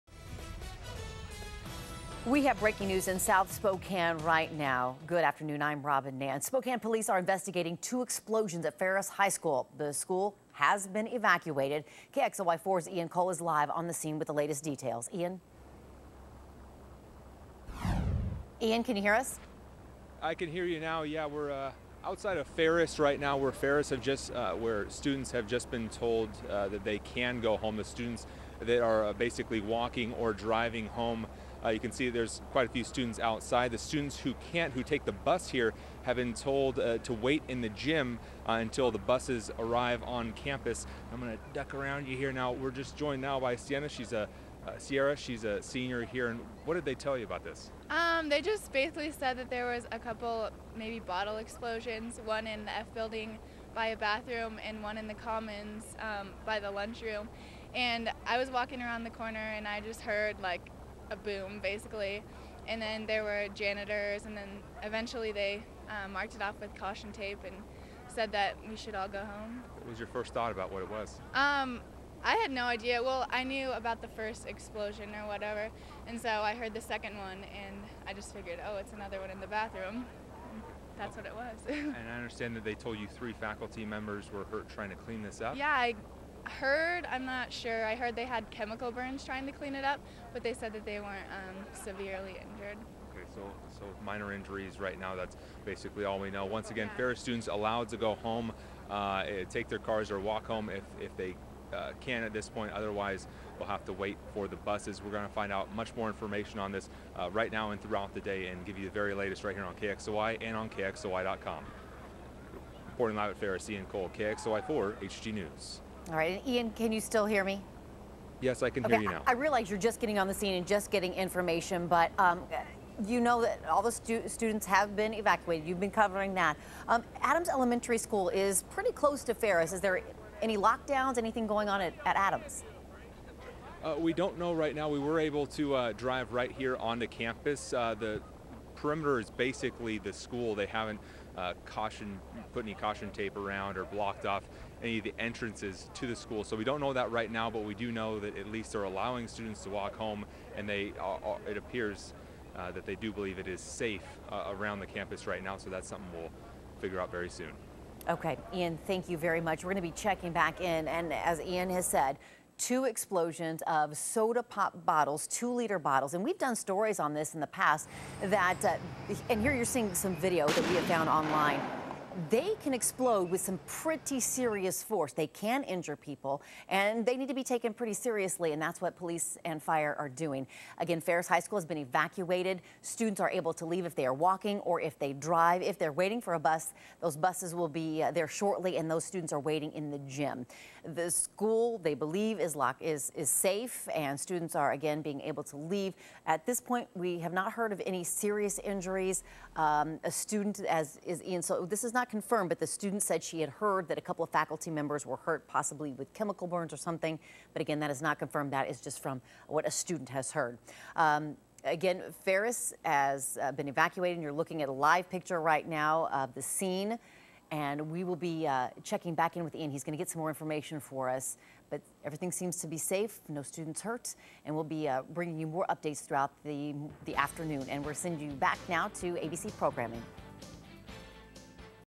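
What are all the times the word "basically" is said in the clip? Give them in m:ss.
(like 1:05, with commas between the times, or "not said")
0:29, 0:48, 1:01, 1:35, 2:19.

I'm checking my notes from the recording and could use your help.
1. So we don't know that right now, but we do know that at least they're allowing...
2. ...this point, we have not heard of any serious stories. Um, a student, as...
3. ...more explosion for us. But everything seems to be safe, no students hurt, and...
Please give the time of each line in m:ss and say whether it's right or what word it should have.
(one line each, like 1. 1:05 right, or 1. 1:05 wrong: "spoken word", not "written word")
1. 2:26 right
2. 3:16 wrong: "injuries", not "stories"
3. 3:40 wrong: "information", not "explosion".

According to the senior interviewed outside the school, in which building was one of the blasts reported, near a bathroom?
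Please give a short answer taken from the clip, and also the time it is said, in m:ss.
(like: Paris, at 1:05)
F building, at 0:52.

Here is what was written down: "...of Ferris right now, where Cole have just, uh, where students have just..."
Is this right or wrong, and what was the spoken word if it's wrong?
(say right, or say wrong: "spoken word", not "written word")
wrong: "Ferris", not "Cole".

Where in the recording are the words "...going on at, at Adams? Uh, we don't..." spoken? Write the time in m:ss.
2:11.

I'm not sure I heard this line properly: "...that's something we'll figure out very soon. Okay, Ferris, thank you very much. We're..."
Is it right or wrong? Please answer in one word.
wrong.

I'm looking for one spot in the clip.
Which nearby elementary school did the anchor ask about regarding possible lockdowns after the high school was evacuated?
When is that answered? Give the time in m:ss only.
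2:07.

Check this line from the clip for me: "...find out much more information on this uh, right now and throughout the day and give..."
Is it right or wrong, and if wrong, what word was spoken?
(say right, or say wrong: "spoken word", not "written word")
right.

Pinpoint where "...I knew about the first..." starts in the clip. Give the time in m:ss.
1:13.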